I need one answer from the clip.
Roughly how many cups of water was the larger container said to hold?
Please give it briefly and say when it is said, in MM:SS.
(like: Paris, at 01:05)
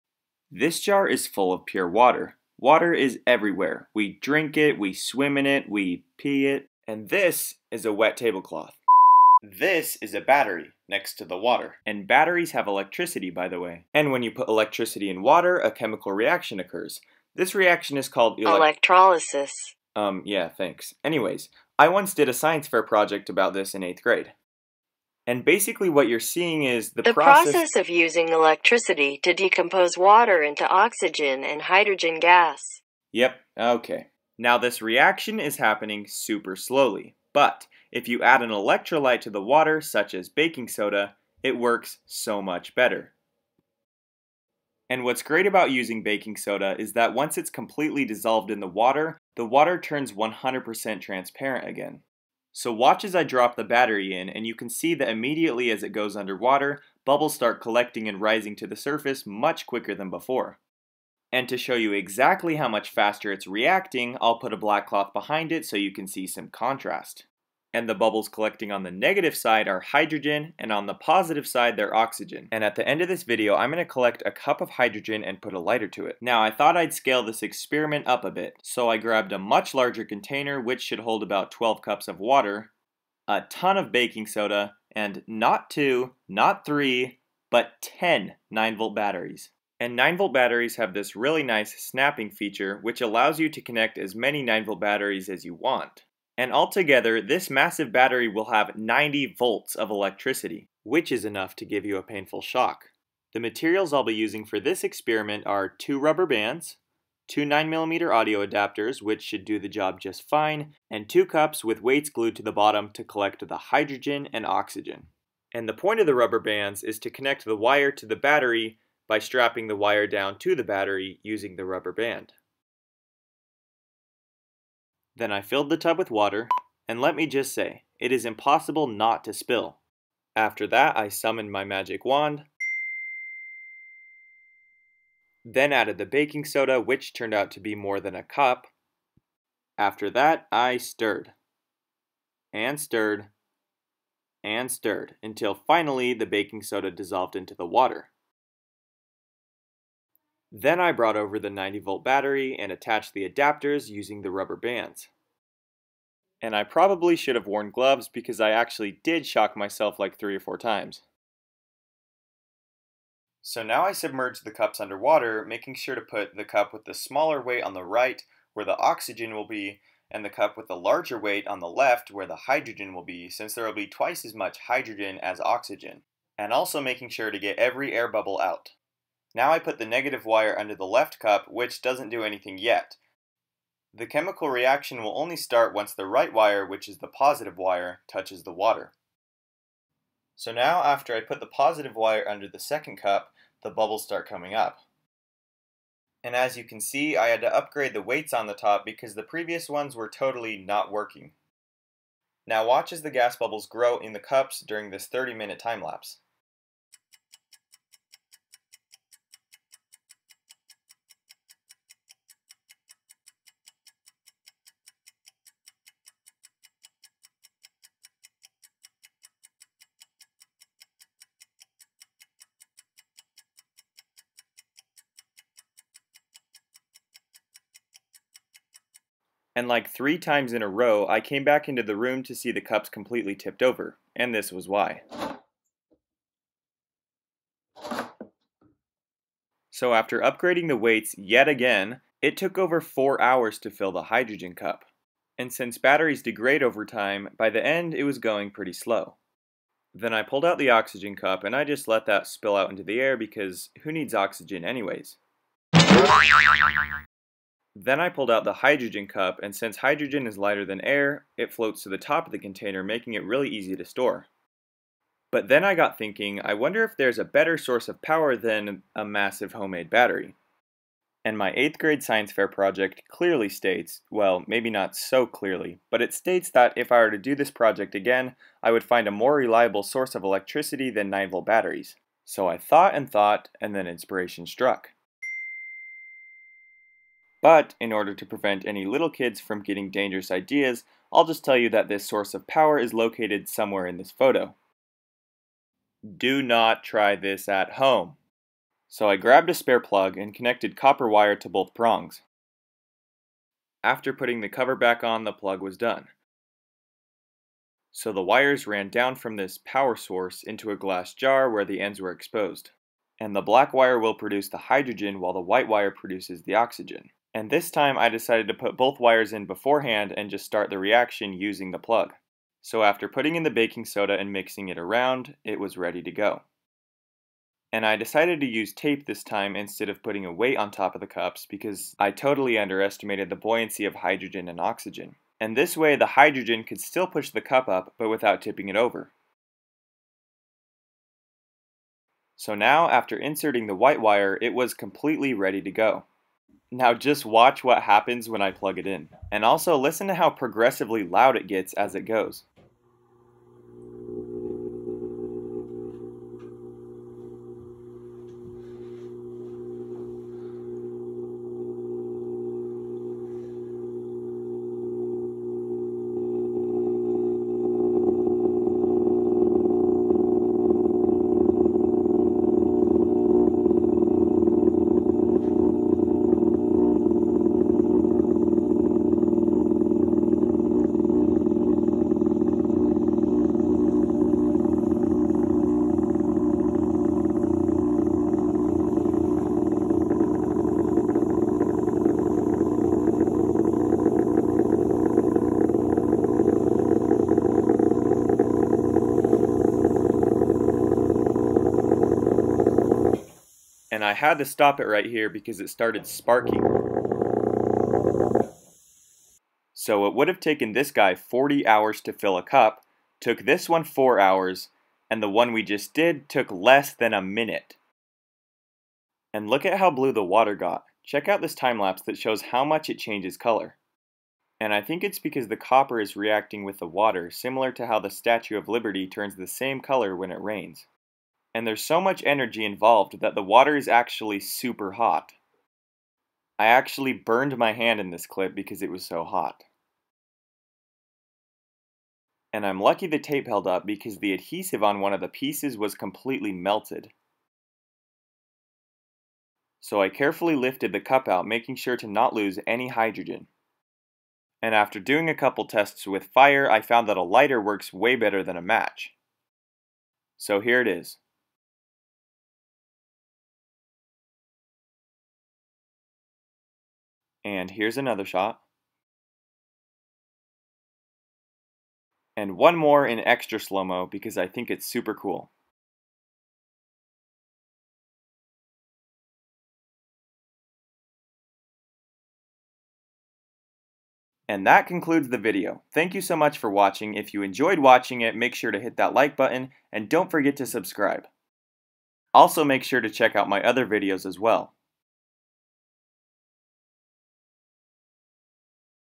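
12 cups, at 01:21.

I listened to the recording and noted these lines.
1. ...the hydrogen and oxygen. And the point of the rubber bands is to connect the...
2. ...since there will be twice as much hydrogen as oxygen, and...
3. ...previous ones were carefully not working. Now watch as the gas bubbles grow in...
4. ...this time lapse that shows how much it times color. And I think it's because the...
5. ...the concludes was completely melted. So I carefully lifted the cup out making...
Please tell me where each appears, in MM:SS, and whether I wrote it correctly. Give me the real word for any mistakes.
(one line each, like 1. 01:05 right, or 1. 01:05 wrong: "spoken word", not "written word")
1. 01:53 right
2. 02:53 right
3. 03:19 wrong: "totally", not "carefully"
4. 07:01 wrong: "changes", not "times"
5. 07:25 wrong: "pieces", not "concludes".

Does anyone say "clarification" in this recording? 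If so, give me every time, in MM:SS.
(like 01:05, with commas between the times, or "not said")
not said.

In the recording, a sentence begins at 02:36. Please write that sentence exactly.
And I probably should have worn gloves because I actually did shock myself like three or four times.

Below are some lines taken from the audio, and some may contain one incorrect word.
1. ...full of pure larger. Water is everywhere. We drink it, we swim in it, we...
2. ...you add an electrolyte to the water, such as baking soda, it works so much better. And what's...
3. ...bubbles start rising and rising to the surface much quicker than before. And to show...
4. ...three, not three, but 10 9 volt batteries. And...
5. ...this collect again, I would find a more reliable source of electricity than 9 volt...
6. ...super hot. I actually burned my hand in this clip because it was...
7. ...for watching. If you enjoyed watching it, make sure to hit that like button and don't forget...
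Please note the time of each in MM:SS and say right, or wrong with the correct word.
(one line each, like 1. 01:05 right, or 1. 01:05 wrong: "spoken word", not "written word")
1. 00:01 wrong: "water", not "larger"
2. 00:38 right
3. 00:57 wrong: "collecting", not "rising"
4. 01:25 wrong: "two", not "three"
5. 04:37 wrong: "project", not "collect"
6. 07:14 right
7. 08:06 right.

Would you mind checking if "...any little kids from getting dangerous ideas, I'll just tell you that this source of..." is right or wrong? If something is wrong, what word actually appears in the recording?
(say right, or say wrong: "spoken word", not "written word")
right.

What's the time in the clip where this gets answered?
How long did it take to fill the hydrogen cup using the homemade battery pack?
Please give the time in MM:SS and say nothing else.
04:02.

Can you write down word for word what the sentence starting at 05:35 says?
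And this way the hydrogen could still push the cup up but without tipping it over.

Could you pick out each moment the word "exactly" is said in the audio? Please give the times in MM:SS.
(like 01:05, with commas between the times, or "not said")
01:01.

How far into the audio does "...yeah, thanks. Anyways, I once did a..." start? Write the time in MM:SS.
00:20.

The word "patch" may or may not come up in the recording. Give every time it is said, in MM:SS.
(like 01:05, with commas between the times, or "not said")
not said.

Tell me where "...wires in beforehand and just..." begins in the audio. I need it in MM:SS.
05:18.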